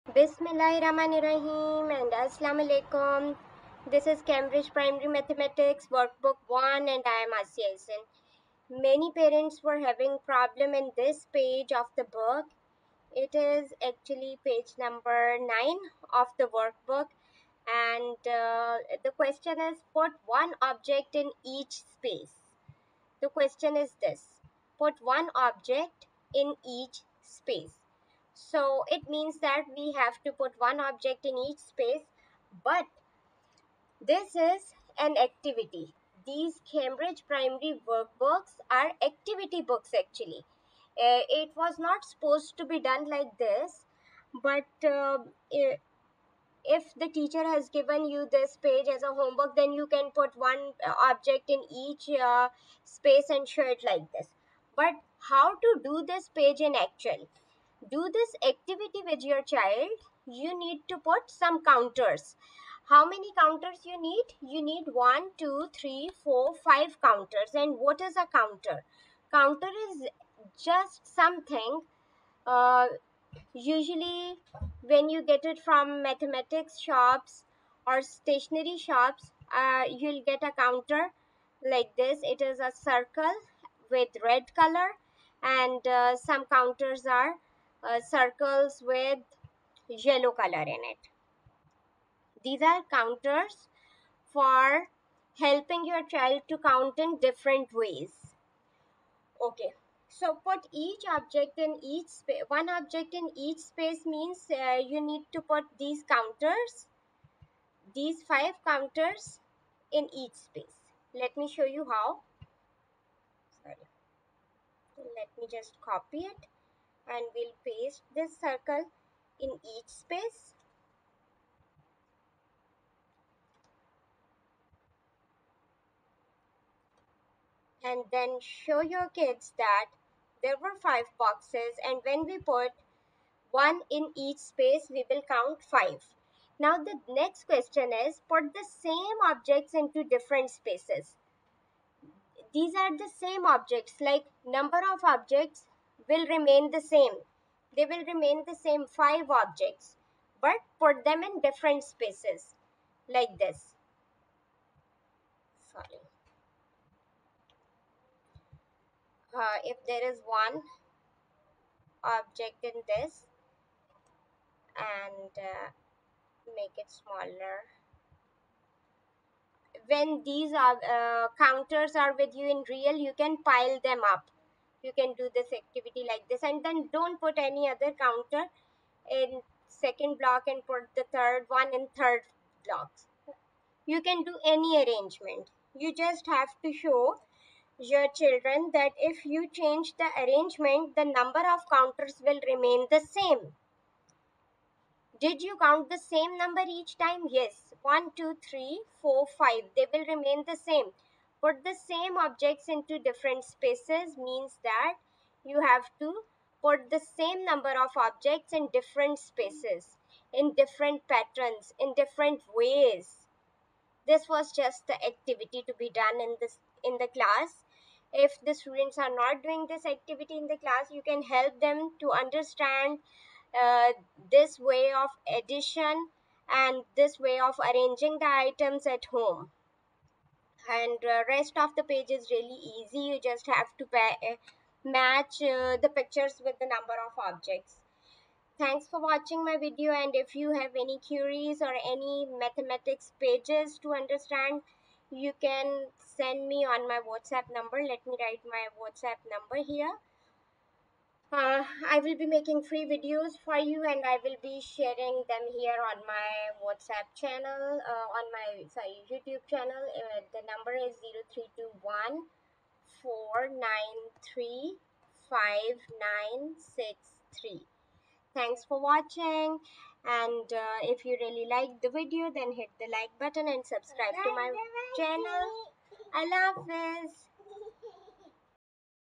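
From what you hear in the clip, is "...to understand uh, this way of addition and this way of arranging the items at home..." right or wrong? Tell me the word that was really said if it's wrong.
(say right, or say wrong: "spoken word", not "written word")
right.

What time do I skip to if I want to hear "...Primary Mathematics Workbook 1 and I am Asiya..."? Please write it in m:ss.
0:04.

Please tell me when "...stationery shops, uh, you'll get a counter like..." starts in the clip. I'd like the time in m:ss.
1:18.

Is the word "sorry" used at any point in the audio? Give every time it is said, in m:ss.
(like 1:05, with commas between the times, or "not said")
1:53, 2:35, 4:18.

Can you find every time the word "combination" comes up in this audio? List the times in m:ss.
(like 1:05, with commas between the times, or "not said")
not said.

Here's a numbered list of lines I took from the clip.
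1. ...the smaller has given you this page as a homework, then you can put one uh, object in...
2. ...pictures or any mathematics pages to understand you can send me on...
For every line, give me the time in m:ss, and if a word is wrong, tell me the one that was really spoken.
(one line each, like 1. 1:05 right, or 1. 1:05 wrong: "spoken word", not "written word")
1. 0:46 wrong: "teacher", not "smaller"
2. 4:01 wrong: "queries", not "pictures".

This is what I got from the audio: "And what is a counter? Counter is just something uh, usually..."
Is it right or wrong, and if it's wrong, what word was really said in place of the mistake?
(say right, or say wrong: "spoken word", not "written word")
right.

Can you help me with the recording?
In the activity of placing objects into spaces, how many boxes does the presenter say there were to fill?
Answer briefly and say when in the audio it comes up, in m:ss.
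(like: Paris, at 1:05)
5, at 2:10.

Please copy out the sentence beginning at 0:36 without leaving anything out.
These Cambridge Primary Workbooks are activity books actually.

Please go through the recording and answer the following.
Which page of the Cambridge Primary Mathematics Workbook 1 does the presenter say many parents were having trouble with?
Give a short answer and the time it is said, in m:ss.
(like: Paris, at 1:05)
9, at 0:14.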